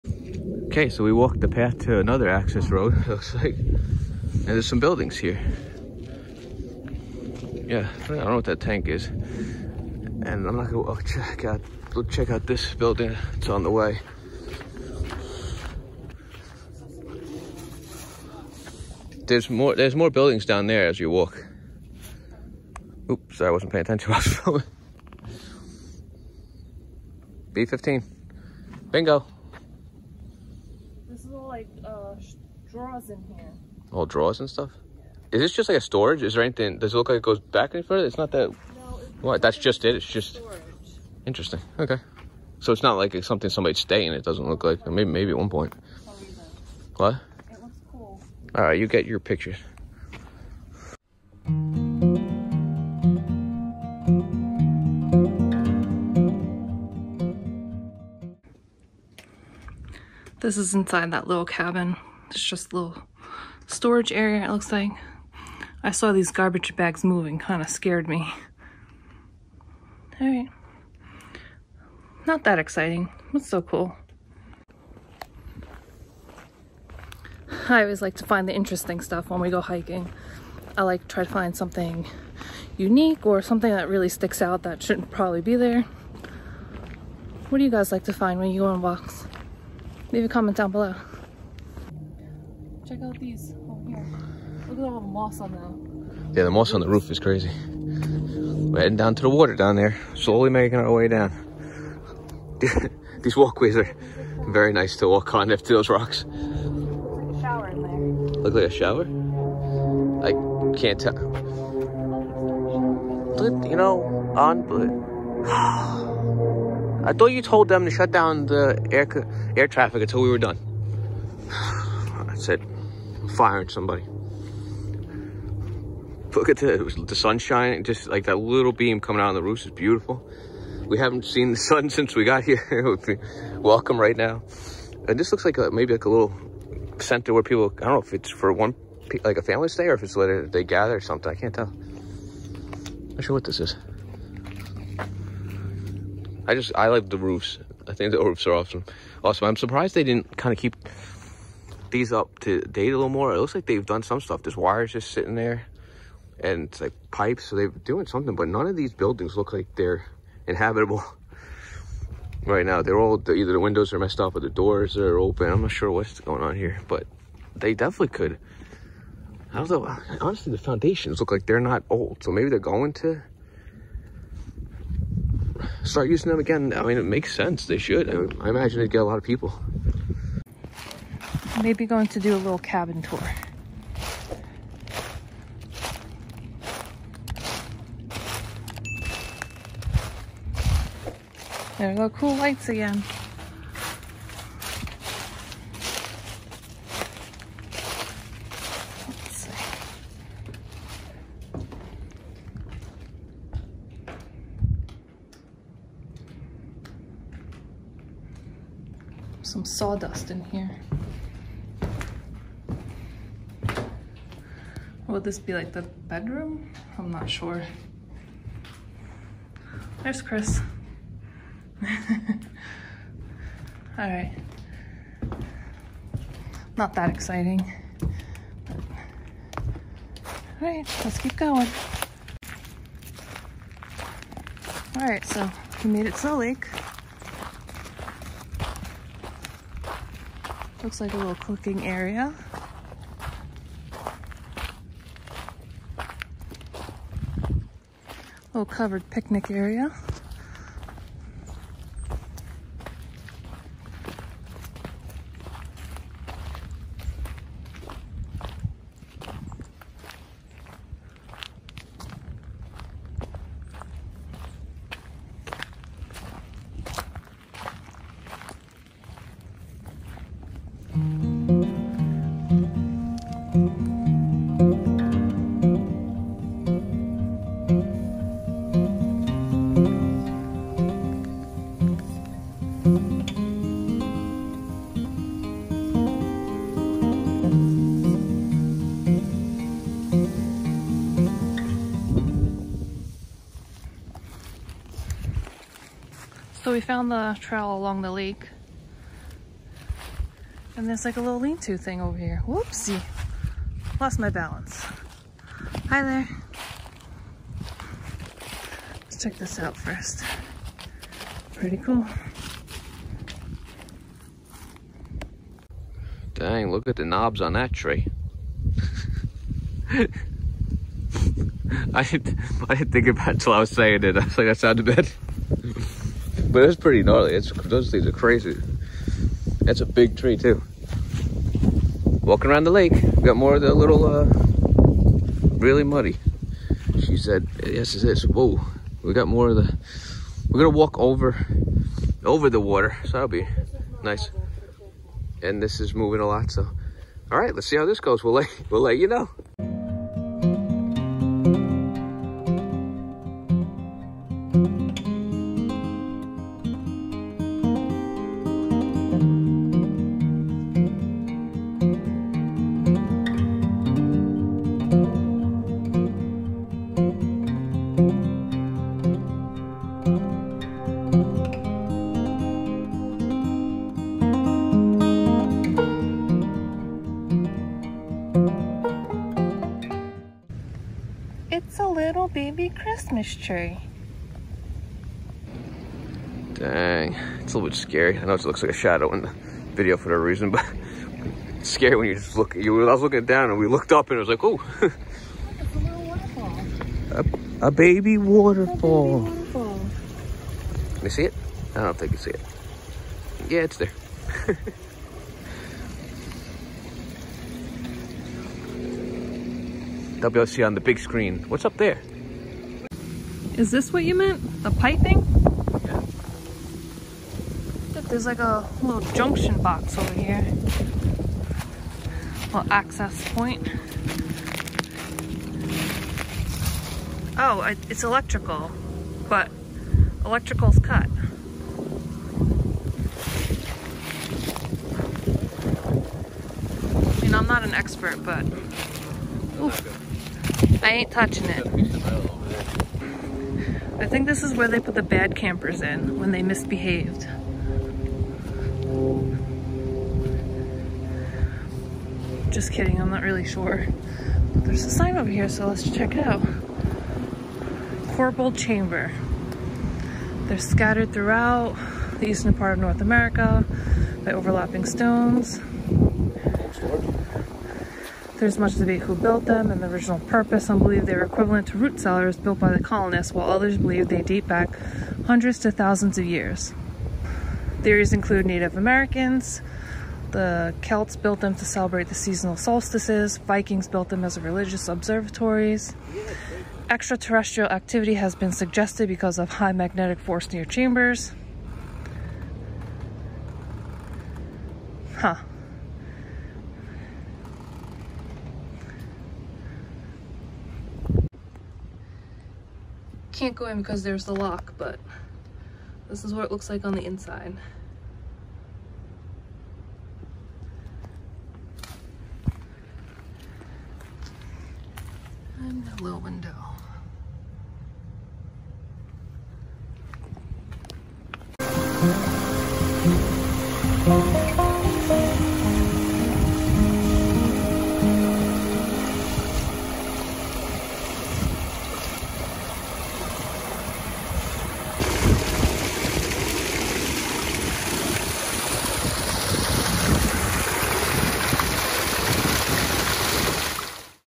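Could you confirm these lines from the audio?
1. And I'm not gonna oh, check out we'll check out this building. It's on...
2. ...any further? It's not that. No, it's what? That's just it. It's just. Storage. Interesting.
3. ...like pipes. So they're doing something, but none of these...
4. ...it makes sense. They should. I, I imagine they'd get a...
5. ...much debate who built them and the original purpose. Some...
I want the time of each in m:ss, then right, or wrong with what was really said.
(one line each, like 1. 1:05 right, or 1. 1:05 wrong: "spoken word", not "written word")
1. 0:09 right
2. 0:37 right
3. 2:36 right
4. 2:56 right
5. 7:48 right.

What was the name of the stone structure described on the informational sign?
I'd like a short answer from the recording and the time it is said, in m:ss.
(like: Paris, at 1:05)
Corbelled Chamber, at 7:38.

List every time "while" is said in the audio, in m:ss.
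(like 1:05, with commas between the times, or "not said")
0:24, 7:53.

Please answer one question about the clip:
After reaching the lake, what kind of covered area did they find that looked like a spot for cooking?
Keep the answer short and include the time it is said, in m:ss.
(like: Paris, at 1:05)
Covered picnic area, at 4:08.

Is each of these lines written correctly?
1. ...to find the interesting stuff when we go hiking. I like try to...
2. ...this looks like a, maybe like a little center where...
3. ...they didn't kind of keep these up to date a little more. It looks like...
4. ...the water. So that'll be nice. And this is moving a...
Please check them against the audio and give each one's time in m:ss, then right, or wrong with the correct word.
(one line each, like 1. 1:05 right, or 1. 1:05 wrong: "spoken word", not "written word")
1. 1:18 right
2. 2:15 right
3. 2:29 right
4. 5:42 right.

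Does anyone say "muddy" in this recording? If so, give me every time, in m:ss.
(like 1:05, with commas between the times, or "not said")
5:35.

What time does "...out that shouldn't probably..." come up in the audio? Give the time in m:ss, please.
1:24.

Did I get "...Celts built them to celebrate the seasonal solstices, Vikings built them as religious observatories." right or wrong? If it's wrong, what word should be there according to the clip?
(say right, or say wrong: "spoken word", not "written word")
right.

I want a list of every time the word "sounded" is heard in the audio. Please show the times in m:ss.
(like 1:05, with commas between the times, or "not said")
5:24.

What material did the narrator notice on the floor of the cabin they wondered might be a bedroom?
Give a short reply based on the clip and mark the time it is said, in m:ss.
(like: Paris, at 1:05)
Sawdust, at 3:29.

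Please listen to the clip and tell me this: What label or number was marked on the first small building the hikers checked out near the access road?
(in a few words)
B15.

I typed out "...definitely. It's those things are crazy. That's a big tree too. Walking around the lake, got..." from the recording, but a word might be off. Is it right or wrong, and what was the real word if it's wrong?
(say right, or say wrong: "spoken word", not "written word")
wrong: "gnarly", not "definitely".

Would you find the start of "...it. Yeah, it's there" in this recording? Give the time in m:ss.
6:42.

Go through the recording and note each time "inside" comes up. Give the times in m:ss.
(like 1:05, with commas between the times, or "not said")
1:00, 8:27.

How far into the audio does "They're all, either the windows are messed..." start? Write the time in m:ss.
2:42.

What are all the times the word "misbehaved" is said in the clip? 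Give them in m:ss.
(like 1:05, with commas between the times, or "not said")
7:26.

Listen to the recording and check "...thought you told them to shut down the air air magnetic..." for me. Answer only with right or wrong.
wrong.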